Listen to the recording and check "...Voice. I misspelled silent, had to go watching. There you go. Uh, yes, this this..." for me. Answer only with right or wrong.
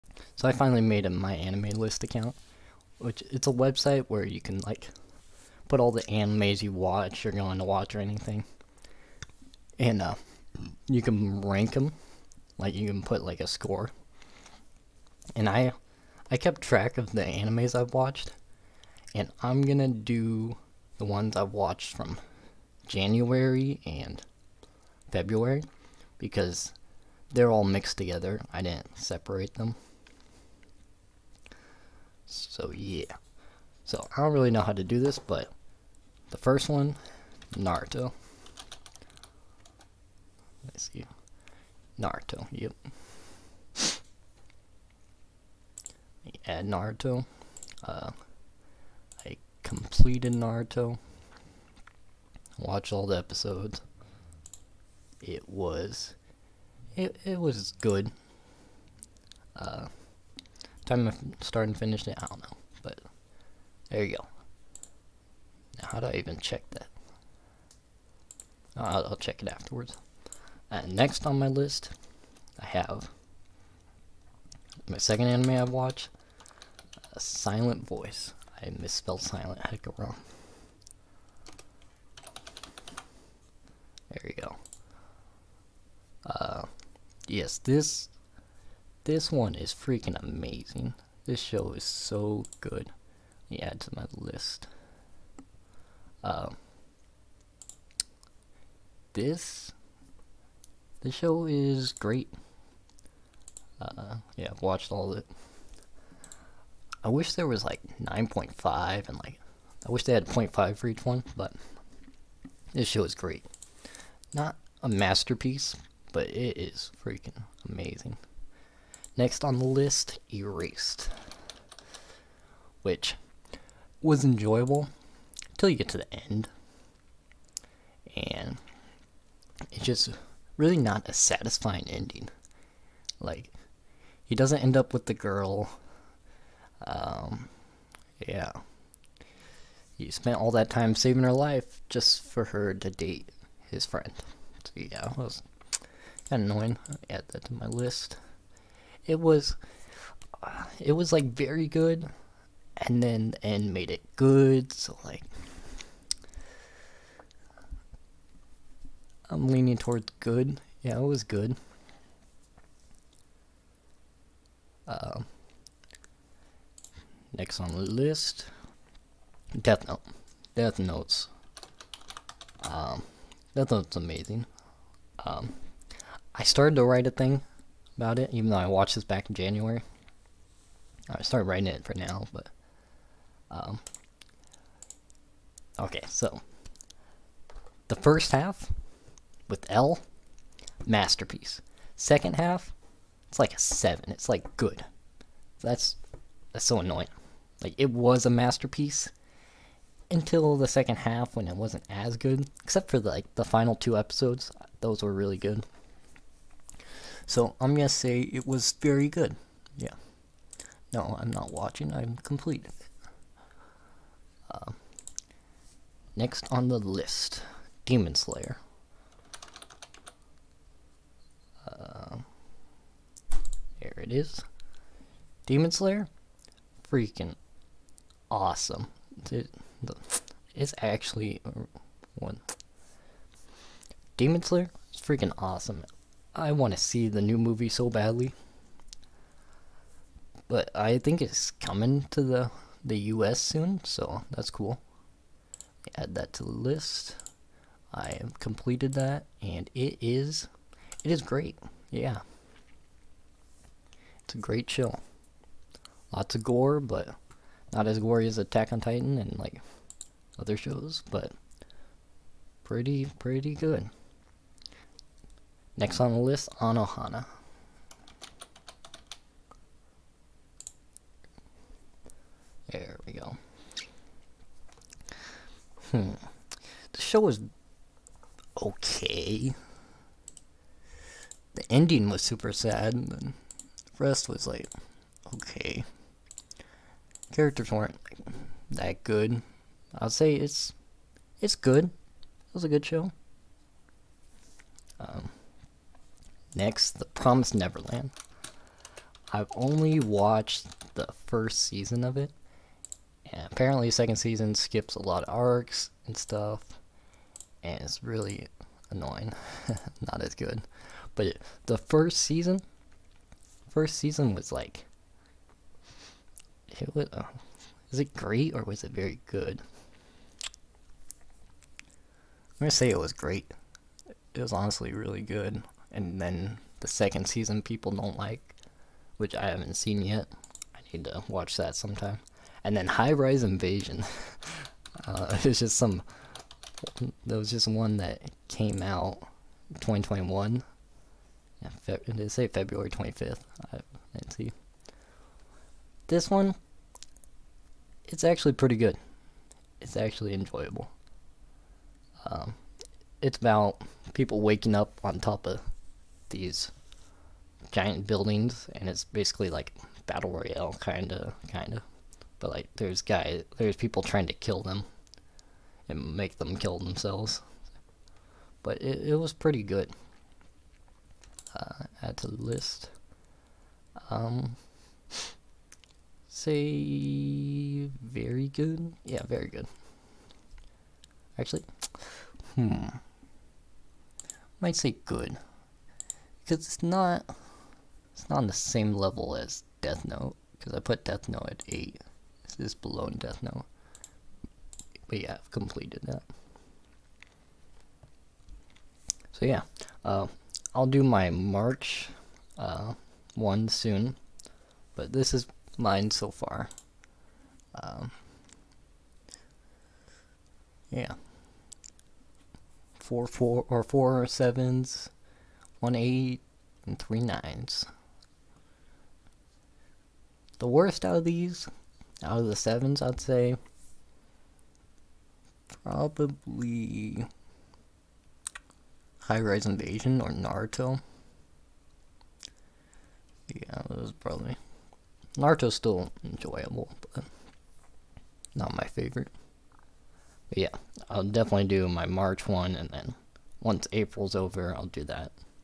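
wrong.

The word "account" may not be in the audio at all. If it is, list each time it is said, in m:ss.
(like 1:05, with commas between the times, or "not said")
0:02.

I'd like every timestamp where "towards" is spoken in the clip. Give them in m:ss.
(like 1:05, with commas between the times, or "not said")
2:39.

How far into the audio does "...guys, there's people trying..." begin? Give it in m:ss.
6:03.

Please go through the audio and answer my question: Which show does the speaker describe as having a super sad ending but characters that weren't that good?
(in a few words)
Anohana.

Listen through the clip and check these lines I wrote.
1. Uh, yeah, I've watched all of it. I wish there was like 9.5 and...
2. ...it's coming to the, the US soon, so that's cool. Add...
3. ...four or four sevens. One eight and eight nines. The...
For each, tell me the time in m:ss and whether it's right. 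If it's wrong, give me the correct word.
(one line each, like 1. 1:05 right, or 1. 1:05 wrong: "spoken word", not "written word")
1. 1:43 right
2. 4:01 right
3. 6:53 wrong: "three", not "eight".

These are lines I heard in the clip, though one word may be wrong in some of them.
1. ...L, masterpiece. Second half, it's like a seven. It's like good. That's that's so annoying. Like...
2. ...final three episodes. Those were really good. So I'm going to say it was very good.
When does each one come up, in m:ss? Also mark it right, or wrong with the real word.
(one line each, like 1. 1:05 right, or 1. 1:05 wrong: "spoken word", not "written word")
1. 3:09 right
2. 3:23 wrong: "two", not "three".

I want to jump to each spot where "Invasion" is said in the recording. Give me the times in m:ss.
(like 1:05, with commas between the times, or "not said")
5:33, 7:09.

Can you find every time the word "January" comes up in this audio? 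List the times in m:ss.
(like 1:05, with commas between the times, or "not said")
0:22, 2:59.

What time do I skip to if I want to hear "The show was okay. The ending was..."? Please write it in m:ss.
4:36.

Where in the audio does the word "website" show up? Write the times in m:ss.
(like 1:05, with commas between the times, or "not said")
0:03.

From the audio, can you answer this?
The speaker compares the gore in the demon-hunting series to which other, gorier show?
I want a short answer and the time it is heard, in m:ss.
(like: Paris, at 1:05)
Attack on Titan, at 4:18.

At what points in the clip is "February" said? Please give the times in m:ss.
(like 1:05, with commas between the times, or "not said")
0:25, 5:42.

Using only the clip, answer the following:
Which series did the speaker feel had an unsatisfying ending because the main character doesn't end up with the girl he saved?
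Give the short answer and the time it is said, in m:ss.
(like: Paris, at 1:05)
Erased, at 2:00.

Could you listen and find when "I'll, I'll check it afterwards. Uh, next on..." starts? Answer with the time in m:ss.
1:08.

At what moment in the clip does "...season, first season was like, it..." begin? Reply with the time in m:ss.
5:12.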